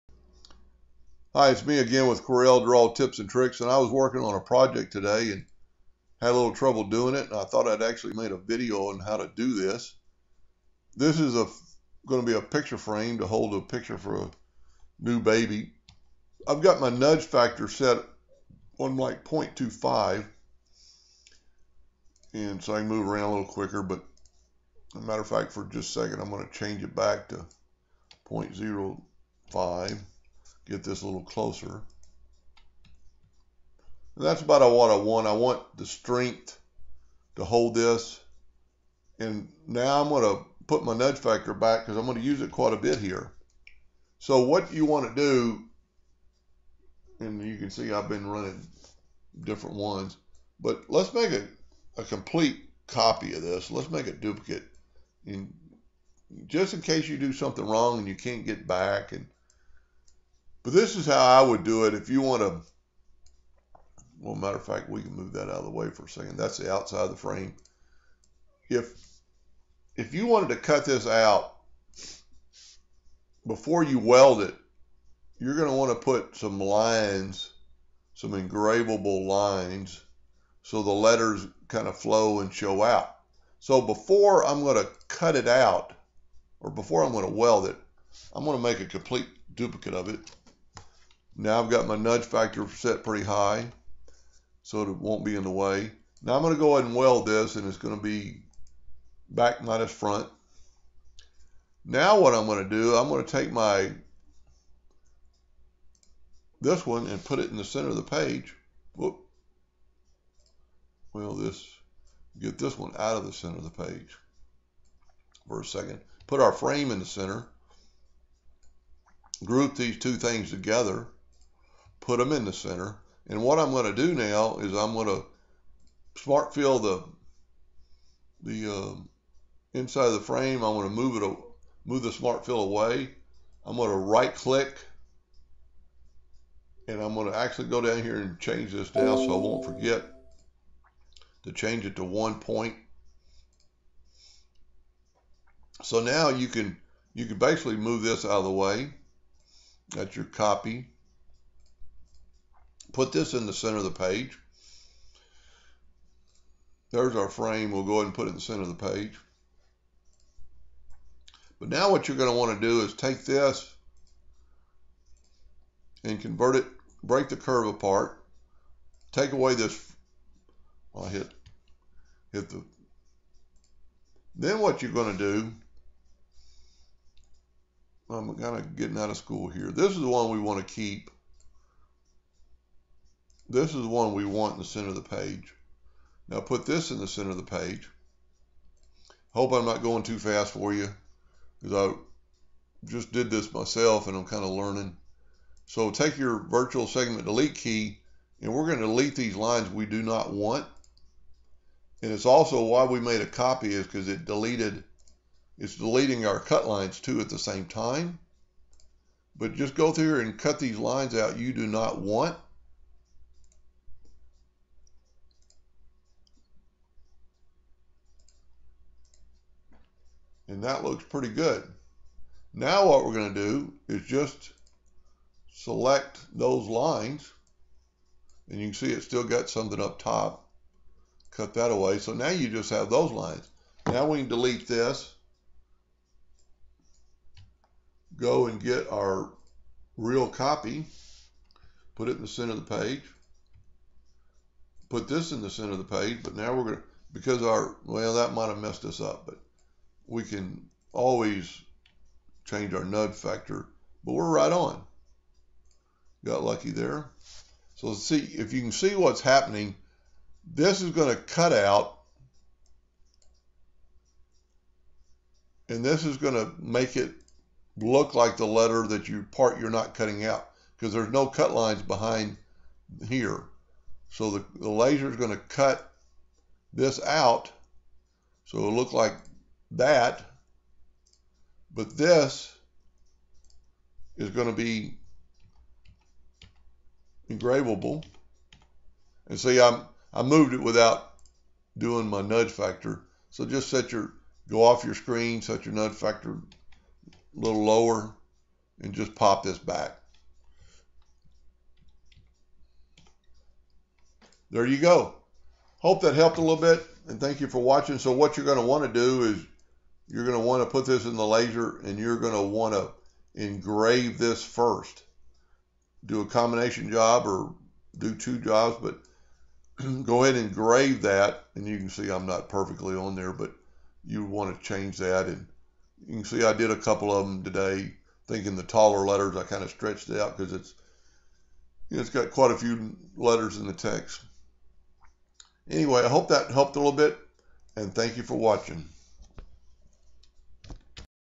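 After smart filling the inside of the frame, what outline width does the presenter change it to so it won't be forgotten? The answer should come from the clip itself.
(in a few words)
1 point.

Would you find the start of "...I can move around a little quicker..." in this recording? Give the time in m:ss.
0:22.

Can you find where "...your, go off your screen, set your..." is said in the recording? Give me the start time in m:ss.
4:53.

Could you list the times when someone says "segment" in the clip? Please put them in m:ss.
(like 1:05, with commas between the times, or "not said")
3:16.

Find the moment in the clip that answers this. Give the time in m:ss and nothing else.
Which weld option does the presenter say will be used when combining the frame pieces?
1:39.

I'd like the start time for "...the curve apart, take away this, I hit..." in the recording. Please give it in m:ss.
2:47.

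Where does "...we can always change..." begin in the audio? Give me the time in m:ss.
4:10.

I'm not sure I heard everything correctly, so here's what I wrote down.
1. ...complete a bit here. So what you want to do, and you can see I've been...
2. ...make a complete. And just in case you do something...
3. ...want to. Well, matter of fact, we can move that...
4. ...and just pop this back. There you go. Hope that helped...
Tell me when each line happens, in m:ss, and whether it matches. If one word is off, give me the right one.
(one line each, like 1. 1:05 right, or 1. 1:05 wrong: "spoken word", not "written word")
1. 0:42 wrong: "quite", not "complete"
2. 0:53 wrong: "duplicate", not "complete"
3. 1:02 right
4. 4:58 right.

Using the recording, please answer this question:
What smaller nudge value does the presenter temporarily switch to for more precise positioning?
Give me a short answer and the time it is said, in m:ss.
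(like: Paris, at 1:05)
0.05, at 0:28.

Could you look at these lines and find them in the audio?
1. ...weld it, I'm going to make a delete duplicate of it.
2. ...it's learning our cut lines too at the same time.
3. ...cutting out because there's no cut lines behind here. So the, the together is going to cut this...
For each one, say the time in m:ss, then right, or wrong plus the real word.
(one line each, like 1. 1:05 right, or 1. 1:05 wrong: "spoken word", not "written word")
1. 1:27 wrong: "complete", not "delete"
2. 3:25 wrong: "deleting", not "learning"
3. 4:29 wrong: "laser", not "together".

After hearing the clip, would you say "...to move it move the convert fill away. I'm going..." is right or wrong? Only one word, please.
wrong.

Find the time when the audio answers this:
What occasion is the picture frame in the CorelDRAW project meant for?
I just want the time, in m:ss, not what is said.
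0:14.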